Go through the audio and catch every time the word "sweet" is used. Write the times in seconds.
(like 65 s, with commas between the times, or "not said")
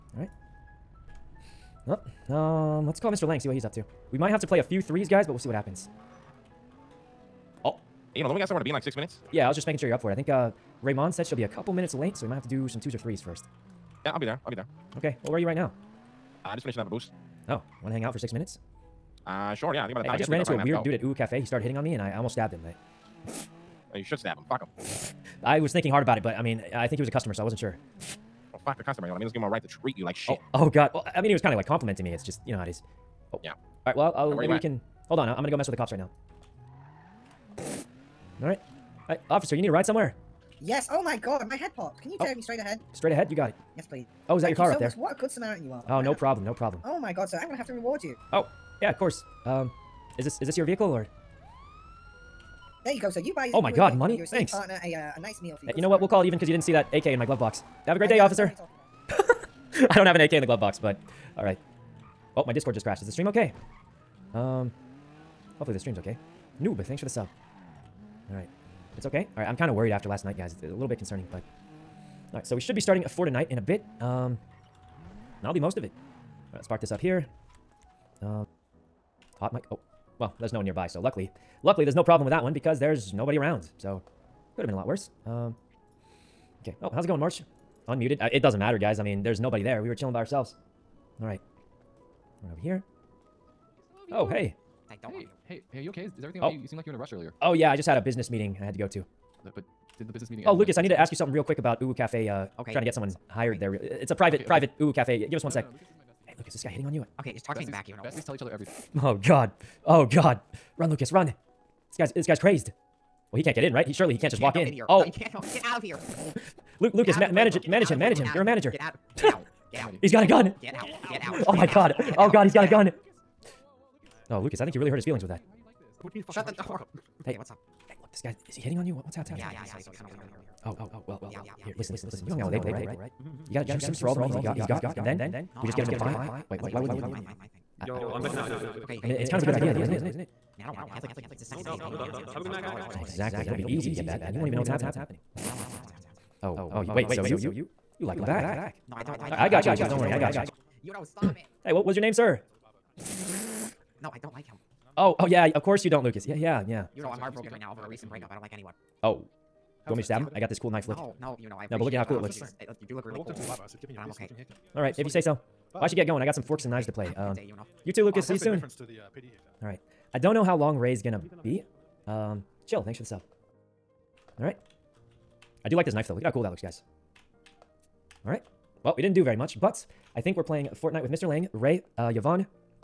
not said.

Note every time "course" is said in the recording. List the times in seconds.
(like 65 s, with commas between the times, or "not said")
48 s, 155 s.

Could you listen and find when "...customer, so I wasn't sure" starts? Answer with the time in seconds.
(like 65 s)
27 s.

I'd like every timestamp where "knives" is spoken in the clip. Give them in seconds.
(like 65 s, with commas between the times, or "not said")
166 s.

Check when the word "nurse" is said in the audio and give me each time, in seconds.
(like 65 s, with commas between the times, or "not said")
not said.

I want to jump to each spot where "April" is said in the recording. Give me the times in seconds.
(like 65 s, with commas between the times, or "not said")
132 s.